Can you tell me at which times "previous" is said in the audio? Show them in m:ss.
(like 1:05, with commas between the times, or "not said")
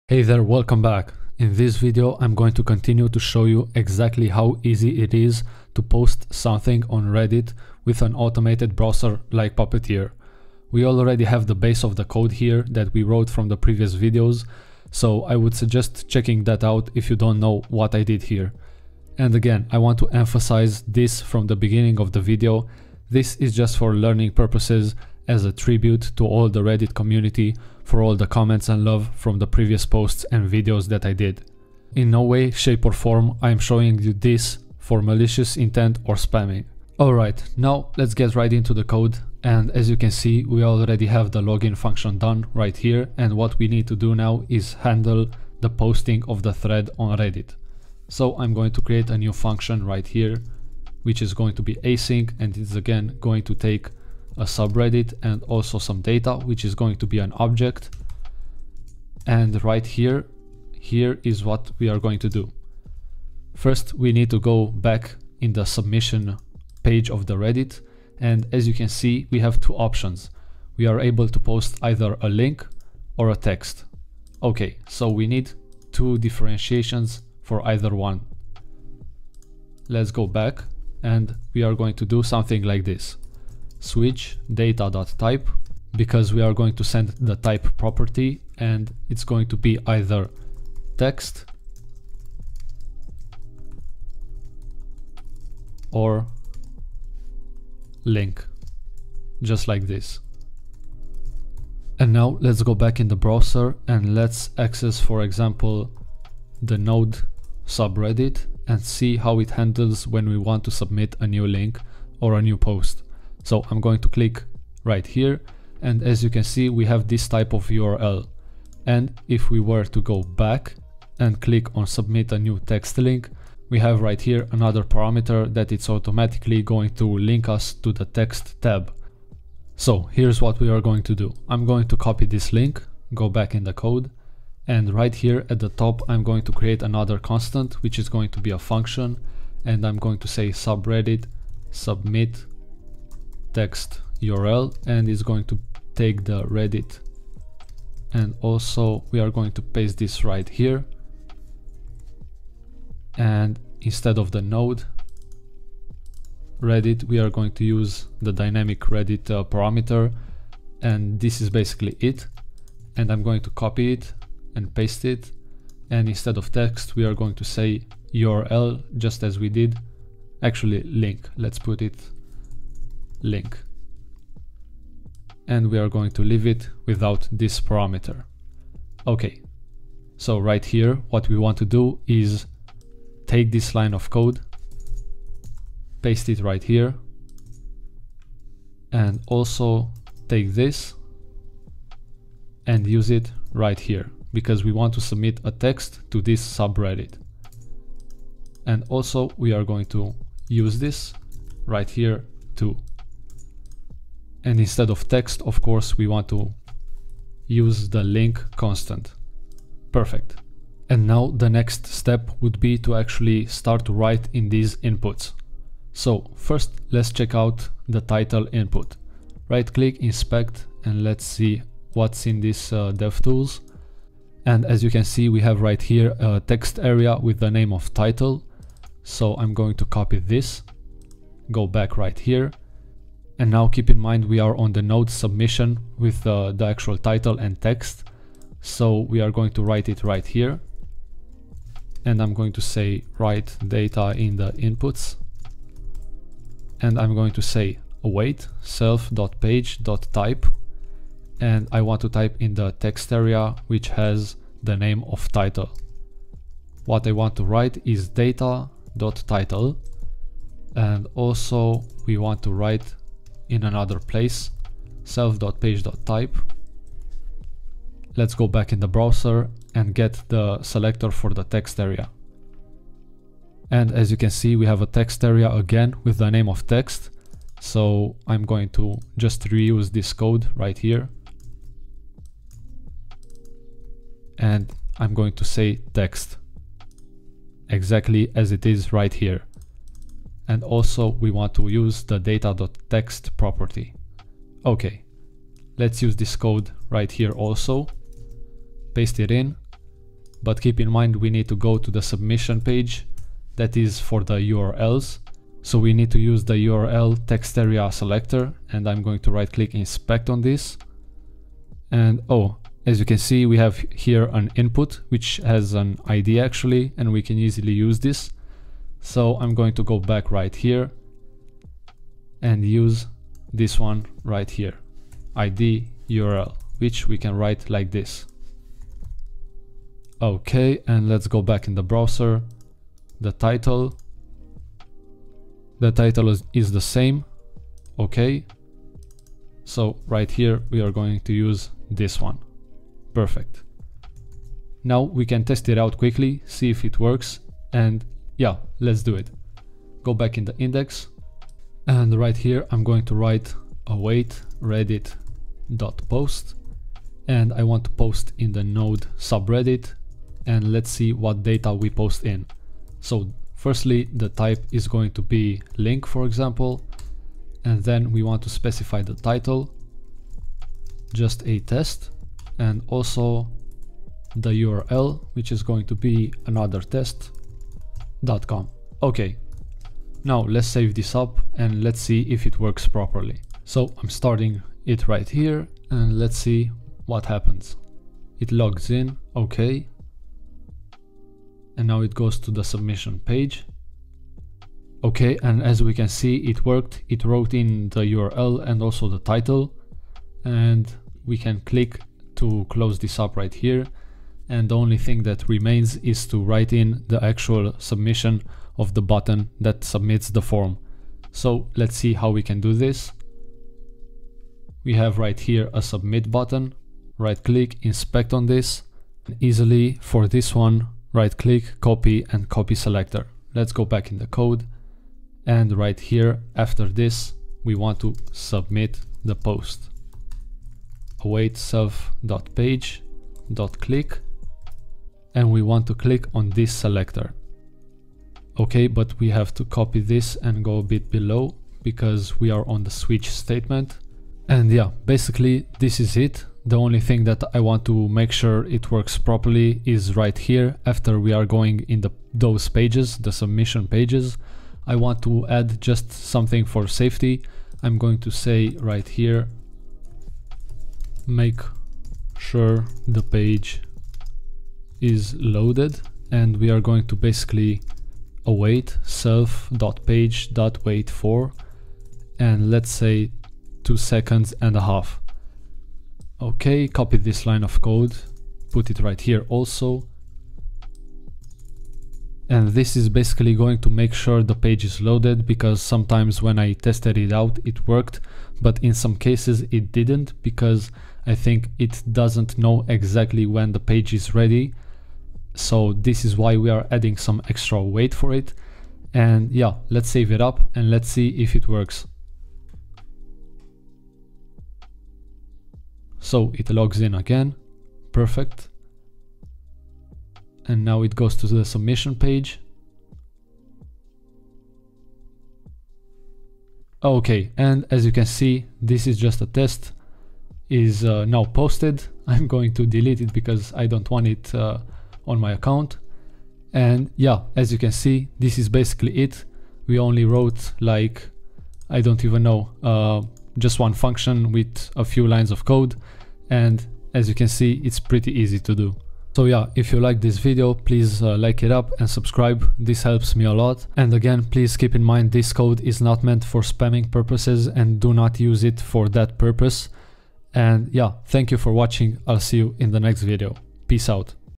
0:13, 0:29.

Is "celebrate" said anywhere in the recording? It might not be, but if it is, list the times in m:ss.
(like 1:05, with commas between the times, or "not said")
not said.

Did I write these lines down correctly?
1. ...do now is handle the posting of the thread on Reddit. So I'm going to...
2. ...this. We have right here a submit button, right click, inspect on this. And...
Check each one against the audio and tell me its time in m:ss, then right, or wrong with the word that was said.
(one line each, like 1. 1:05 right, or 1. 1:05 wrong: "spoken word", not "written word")
1. 0:43 right
2. 6:52 right.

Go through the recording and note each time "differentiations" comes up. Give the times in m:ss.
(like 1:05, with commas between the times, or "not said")
1:16.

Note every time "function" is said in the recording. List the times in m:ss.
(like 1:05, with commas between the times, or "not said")
0:41, 0:49, 2:18, 8:53.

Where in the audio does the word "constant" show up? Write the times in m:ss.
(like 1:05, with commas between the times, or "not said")
2:17, 3:28.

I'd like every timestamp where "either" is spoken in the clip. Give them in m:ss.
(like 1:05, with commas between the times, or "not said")
1:11, 1:17, 1:29.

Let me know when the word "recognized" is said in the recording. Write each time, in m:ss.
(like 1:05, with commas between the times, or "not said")
not said.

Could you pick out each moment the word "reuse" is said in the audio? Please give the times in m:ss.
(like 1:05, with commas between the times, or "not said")
4:39.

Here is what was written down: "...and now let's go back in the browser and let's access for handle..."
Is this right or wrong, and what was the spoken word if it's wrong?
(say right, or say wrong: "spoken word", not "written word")
wrong: "example", not "handle".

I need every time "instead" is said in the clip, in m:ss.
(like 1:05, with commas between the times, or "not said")
2:33, 2:46, 3:24.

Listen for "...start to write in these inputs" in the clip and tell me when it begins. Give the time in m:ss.
3:33.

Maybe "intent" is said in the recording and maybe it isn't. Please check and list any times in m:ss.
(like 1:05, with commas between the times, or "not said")
0:35.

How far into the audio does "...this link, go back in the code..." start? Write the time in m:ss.
2:12.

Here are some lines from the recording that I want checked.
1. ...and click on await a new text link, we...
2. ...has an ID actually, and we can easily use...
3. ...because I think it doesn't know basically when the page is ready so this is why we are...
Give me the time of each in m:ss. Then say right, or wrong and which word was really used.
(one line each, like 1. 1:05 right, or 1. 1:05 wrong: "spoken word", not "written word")
1. 2:01 wrong: "submit", not "await"
2. 5:15 right
3. 8:10 wrong: "exactly", not "basically".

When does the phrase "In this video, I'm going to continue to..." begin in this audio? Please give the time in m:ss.
0:01.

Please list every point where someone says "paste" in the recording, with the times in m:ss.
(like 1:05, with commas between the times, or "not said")
2:29, 2:44, 3:06, 4:58.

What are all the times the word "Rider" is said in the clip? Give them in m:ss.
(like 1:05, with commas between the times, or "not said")
not said.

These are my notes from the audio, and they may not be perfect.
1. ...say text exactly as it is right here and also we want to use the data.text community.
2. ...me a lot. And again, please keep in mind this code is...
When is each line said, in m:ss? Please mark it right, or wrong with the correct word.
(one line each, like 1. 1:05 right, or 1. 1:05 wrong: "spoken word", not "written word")
1. 4:45 wrong: "property", not "community"
2. 9:03 right.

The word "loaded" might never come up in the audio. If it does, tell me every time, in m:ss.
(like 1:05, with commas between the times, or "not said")
7:45, 8:05.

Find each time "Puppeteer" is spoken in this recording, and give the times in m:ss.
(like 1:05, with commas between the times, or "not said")
0:09.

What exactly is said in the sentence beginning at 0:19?
And again, I want to emphasize this from the beginning of the video.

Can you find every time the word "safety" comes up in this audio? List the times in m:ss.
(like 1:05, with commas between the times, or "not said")
7:36.